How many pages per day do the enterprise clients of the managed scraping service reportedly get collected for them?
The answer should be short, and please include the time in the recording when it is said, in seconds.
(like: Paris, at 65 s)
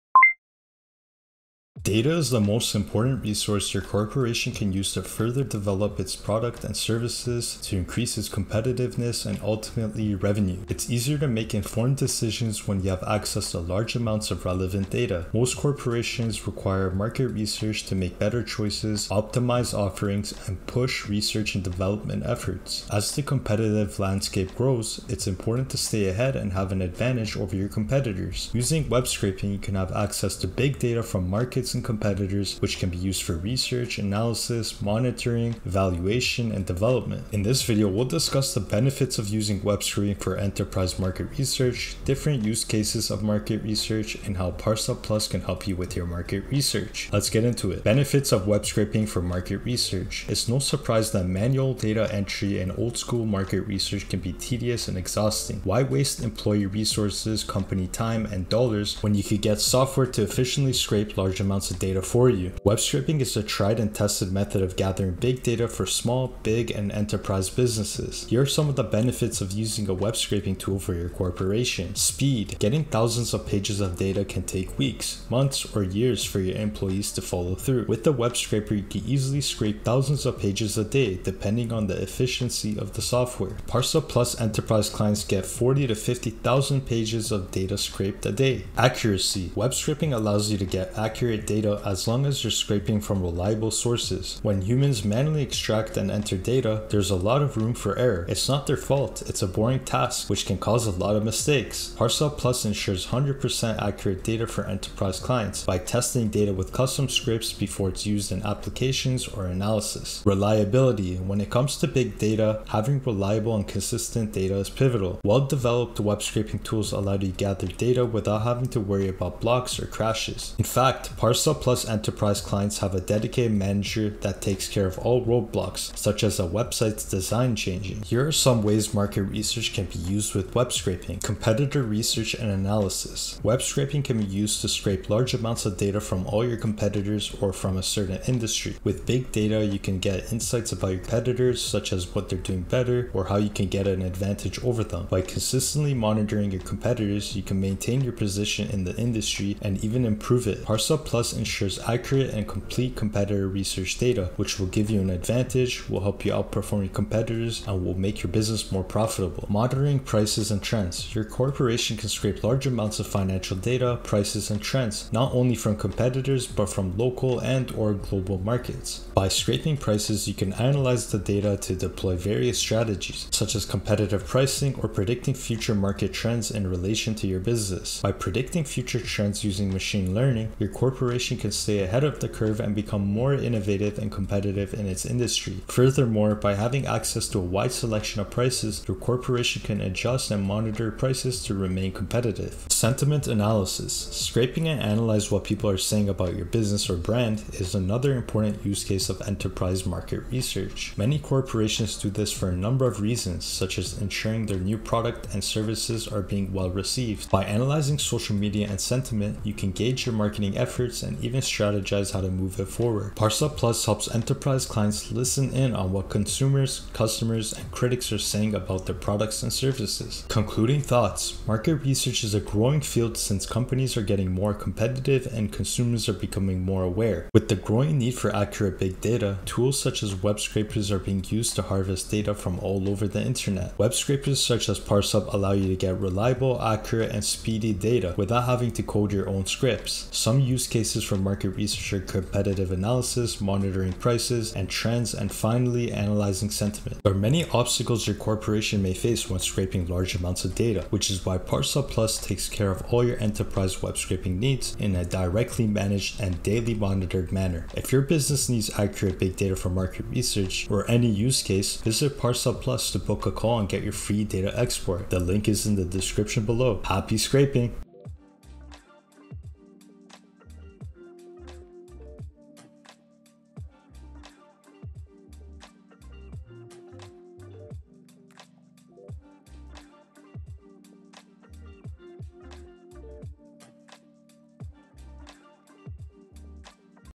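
40 to 50,000, at 85 s.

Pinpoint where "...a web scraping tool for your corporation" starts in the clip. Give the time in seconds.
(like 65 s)
69 s.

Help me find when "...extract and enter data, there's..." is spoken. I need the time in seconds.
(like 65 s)
95 s.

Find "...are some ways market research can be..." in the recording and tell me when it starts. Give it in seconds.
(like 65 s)
128 s.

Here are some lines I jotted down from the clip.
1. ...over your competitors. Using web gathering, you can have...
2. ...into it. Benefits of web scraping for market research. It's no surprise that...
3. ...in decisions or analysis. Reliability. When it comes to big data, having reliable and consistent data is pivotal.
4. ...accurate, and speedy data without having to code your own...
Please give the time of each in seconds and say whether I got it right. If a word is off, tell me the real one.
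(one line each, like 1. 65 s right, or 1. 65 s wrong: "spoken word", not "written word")
1. 27 s wrong: "scraping", not "gathering"
2. 47 s right
3. 108 s wrong: "applications", not "decisions"
4. 236 s right.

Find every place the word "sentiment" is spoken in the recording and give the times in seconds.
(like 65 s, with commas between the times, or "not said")
192 s, 208 s, 246 s.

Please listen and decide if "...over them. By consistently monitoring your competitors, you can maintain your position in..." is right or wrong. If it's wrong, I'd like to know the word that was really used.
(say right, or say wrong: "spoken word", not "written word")
right.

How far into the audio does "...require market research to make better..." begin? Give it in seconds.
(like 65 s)
16 s.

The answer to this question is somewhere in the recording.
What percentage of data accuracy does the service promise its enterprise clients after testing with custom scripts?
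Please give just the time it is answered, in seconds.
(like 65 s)
103 s.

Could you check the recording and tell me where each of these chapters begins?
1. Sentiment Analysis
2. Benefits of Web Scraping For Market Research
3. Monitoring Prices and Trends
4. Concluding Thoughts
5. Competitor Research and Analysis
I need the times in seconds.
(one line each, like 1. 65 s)
1. 192 s
2. 48 s
3. 159 s
4. 220 s
5. 131 s.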